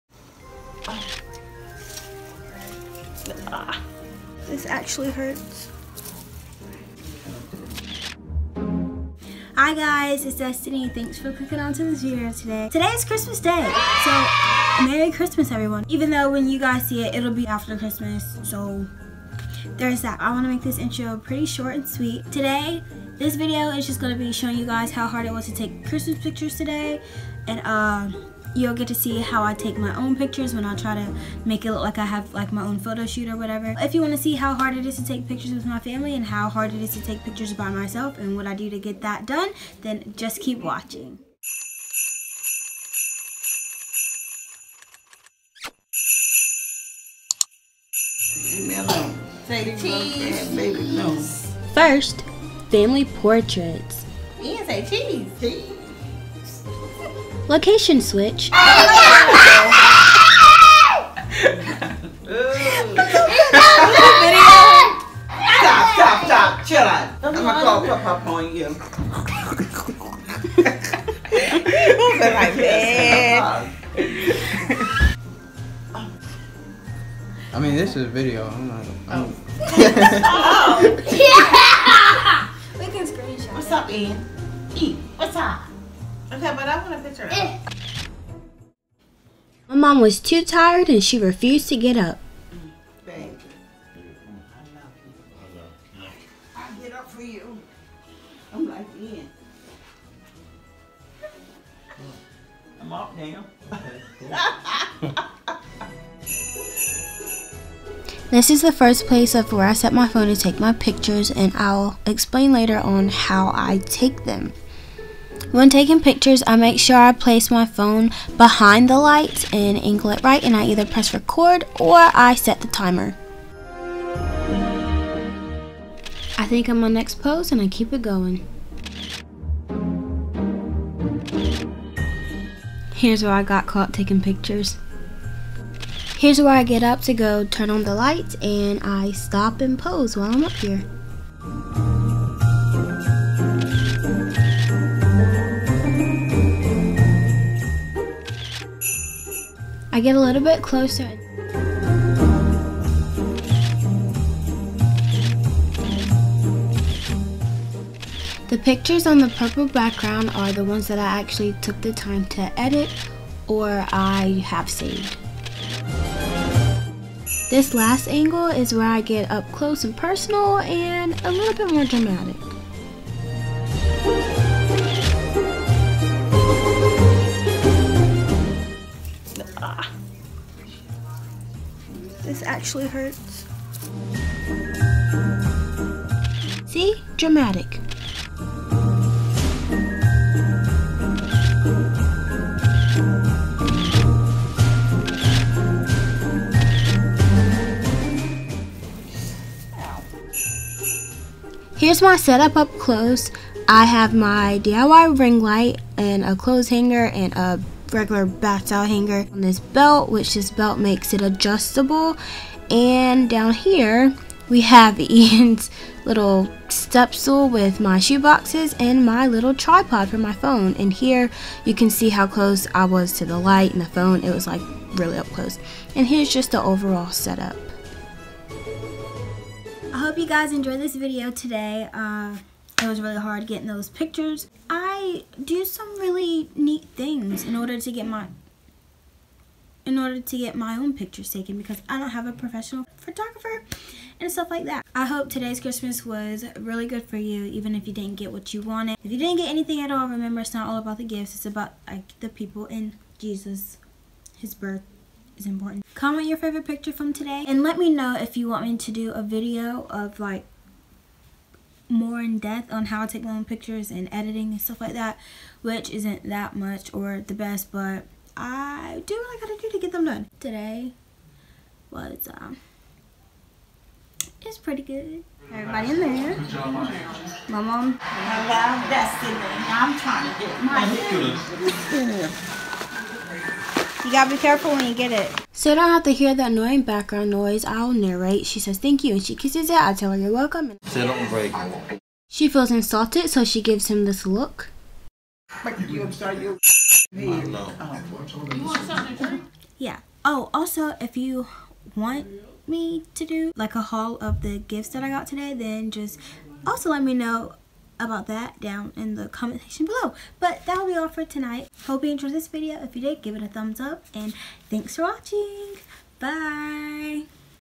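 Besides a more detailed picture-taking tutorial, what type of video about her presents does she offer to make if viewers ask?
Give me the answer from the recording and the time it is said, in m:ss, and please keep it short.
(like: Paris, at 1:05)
A haul, at 5:03.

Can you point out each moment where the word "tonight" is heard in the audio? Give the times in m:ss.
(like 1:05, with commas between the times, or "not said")
5:11.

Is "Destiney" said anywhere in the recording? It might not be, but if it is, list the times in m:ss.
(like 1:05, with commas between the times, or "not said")
0:10, 4:38.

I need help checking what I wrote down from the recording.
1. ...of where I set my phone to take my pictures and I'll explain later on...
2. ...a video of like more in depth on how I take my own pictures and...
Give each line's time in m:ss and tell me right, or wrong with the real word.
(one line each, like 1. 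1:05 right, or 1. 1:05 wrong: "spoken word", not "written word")
1. 1:49 right
2. 4:19 right.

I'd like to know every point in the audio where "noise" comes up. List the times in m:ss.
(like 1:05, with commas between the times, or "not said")
4:47.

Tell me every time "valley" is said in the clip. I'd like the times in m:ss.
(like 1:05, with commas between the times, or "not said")
not said.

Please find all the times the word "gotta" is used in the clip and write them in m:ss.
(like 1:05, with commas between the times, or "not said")
4:29, 4:44.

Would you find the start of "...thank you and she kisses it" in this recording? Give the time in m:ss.
4:48.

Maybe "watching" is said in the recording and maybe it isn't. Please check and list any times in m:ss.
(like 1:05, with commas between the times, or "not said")
0:40, 5:15.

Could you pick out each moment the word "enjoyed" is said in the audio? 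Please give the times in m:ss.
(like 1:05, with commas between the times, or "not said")
3:50, 5:12.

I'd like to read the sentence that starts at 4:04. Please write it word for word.
I hope today's Christmas was really good for you even if you didn't get what you wanted.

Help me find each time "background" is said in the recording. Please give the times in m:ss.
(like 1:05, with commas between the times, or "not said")
2:39, 4:46.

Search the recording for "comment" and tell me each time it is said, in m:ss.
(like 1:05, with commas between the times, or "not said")
4:15, 5:09.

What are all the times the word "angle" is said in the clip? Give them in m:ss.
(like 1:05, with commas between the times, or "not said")
1:59, 2:48.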